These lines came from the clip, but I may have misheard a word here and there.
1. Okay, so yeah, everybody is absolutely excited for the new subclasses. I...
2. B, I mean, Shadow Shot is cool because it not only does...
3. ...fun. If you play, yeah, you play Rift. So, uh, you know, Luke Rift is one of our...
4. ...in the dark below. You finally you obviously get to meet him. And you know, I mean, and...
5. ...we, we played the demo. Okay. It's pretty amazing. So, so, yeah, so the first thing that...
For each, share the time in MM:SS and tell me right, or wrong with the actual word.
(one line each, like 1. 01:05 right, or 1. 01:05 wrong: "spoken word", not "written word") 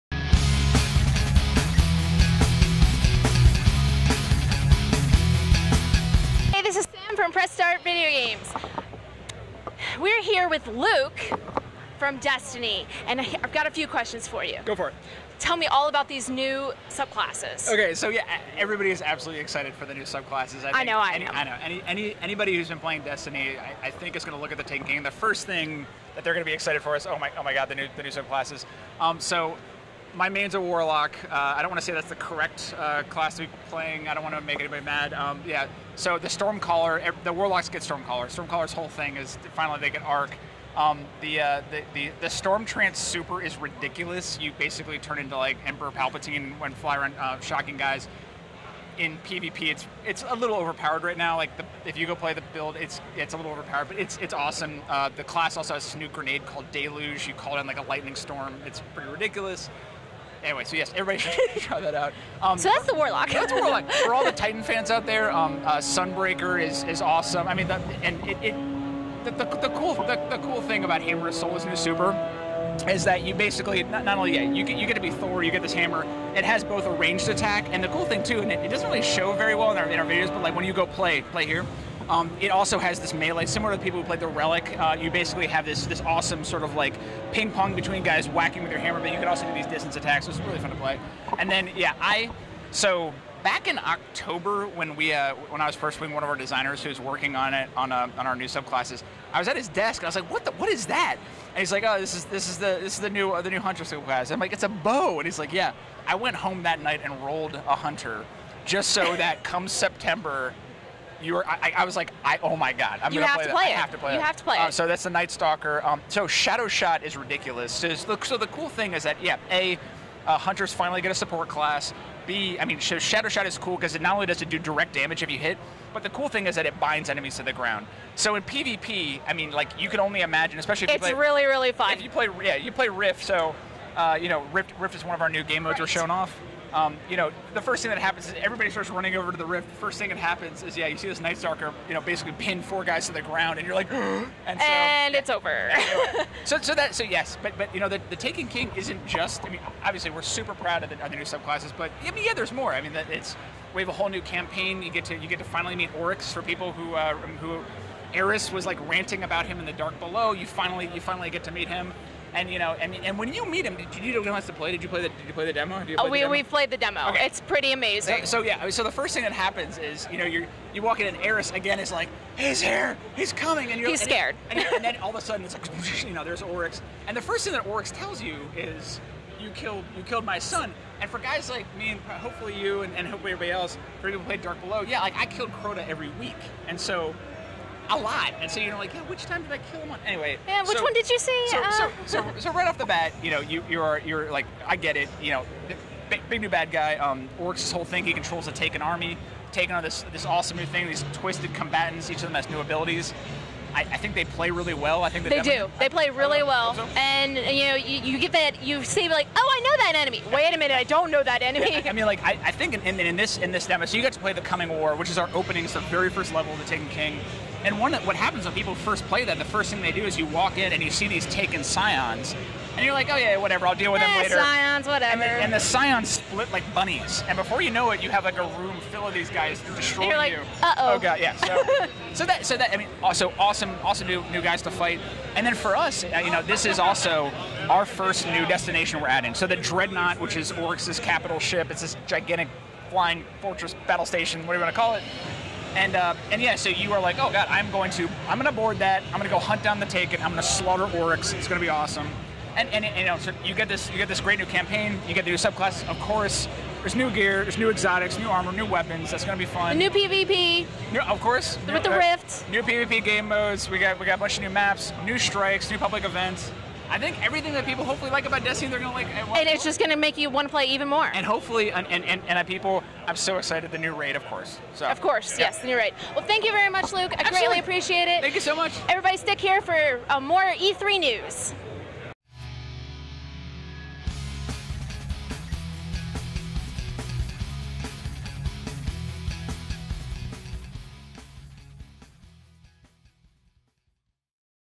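1. 00:17 right
2. 02:02 right
3. 02:11 wrong: "Rift", not "Luke"
4. 02:39 wrong: "finally", not "obviously"
5. 02:46 right.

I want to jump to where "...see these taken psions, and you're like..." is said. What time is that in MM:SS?
03:40.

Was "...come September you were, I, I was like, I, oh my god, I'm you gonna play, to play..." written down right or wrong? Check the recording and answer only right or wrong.
right.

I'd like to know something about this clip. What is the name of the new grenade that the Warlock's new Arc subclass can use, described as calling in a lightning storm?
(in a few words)
Deluge.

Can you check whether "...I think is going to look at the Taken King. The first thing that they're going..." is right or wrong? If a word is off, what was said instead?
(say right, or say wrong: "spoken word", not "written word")
right.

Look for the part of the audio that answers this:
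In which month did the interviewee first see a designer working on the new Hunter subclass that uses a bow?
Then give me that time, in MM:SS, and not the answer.
01:33.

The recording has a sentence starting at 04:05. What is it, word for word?
And uh, and yeah, so you are like, oh god, I'm going to I'm going to board that.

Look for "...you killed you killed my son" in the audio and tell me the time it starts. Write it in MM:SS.
02:59.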